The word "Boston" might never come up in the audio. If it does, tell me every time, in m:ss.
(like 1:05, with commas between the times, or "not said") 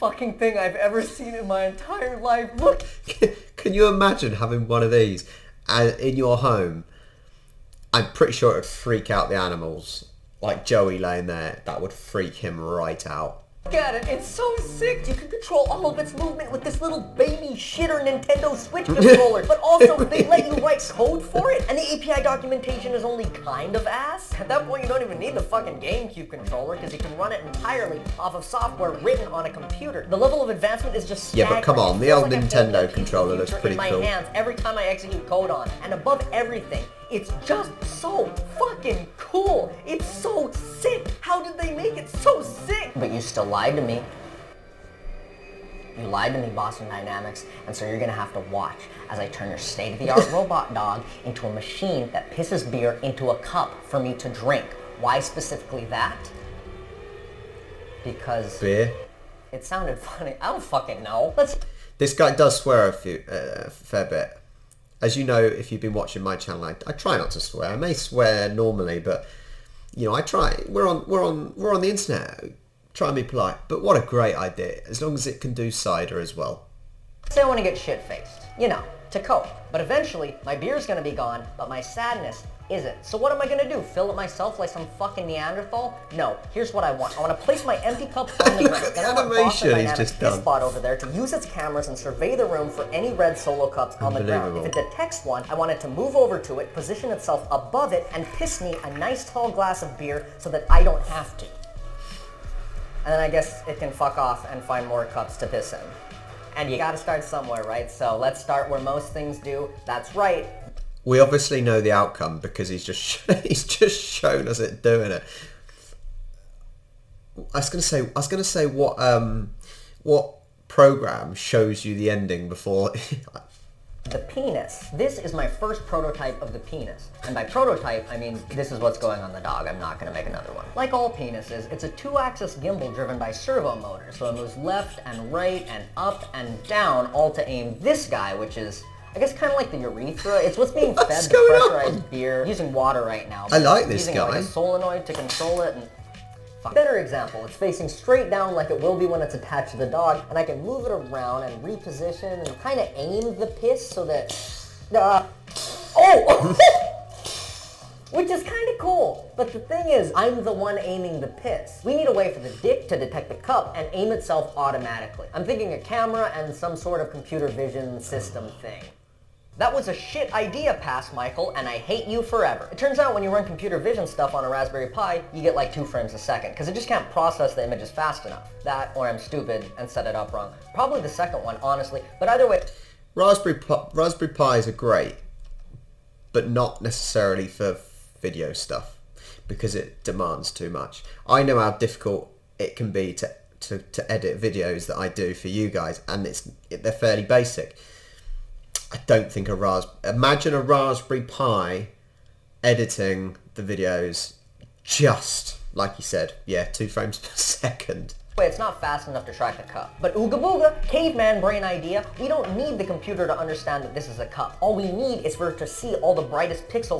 0:46, 1:29.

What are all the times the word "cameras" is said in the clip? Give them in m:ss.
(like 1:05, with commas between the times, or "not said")
1:31, 2:45.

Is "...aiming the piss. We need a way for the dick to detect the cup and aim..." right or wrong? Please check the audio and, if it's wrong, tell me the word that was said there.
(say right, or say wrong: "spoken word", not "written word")
right.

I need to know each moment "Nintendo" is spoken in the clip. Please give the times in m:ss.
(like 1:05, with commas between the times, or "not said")
0:18, 0:32.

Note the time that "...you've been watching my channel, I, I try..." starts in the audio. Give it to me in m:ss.
1:05.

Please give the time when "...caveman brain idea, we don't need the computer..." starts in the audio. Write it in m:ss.
3:30.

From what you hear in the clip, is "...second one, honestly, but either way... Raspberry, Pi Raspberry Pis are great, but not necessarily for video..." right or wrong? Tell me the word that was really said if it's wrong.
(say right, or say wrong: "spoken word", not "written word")
right.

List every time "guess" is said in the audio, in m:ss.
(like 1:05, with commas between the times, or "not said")
1:43, 2:19.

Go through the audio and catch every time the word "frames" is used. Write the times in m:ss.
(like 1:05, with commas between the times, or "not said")
2:55, 3:26.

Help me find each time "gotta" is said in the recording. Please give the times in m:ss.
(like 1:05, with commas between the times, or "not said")
1:46.